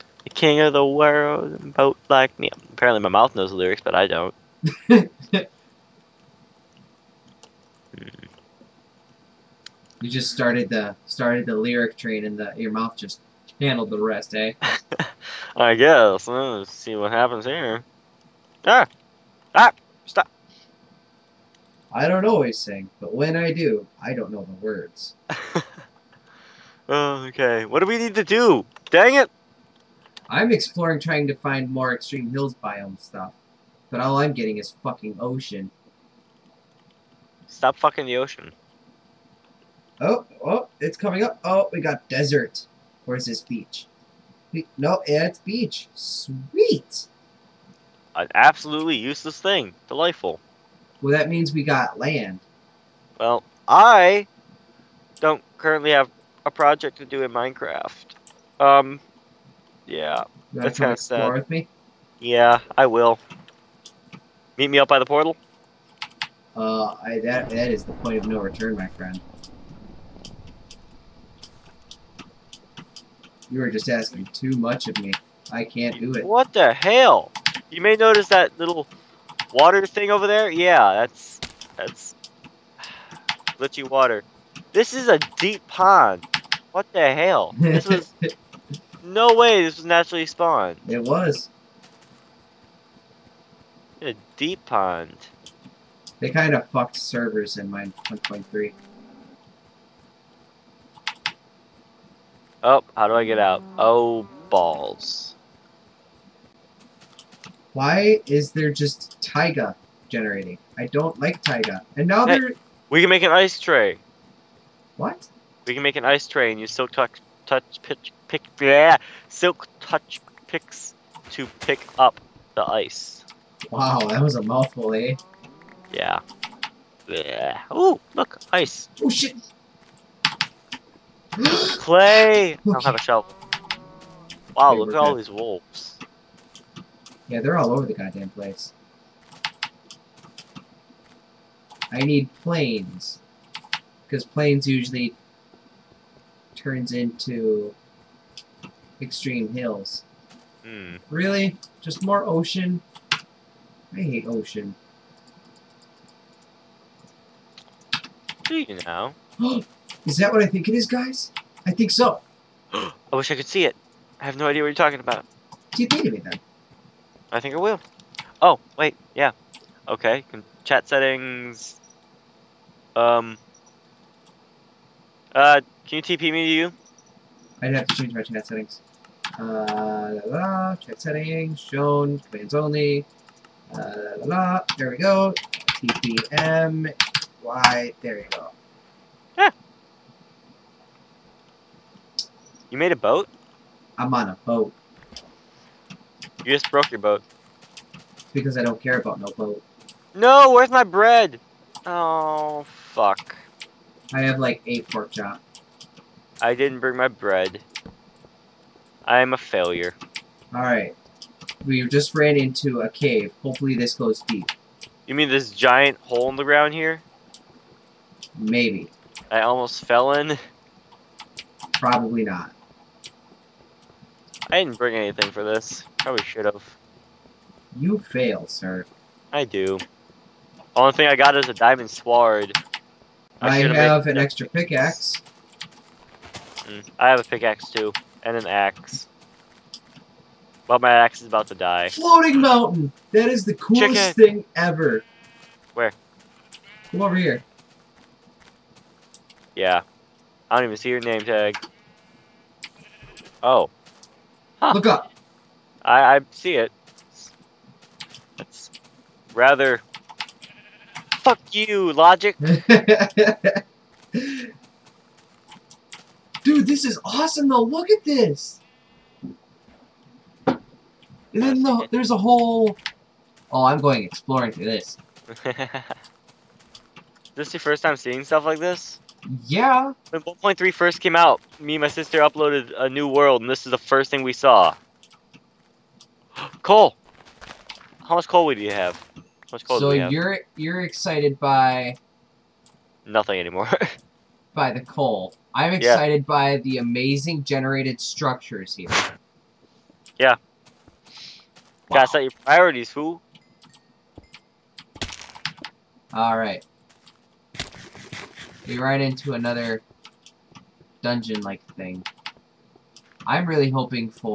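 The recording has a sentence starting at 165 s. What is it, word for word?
Do you think of me then?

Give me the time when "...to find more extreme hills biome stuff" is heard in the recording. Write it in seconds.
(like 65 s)
31 s.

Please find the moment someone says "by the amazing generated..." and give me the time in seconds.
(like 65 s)
296 s.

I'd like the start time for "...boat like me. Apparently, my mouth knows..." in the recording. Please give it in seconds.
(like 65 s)
1 s.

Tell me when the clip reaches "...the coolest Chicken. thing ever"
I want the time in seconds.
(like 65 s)
243 s.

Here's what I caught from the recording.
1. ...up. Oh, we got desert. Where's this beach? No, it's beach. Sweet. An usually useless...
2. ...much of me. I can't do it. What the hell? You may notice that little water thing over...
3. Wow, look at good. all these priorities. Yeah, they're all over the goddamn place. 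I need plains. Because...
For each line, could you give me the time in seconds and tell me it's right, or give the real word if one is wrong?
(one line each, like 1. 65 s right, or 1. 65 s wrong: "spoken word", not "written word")
1. 41 s wrong: "absolutely", not "usually"
2. 74 s right
3. 134 s wrong: "wolves", not "priorities".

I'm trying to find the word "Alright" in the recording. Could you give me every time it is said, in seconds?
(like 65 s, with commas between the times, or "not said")
210 s, 306 s.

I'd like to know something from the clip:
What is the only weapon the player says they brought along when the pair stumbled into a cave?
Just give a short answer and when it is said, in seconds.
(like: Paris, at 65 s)
diamond sword, at 231 s.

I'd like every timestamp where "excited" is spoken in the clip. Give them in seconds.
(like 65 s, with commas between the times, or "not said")
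290 s, 295 s.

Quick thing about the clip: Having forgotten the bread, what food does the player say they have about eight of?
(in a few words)
pork chop.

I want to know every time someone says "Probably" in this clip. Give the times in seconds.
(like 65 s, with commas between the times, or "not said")
221 s, 225 s.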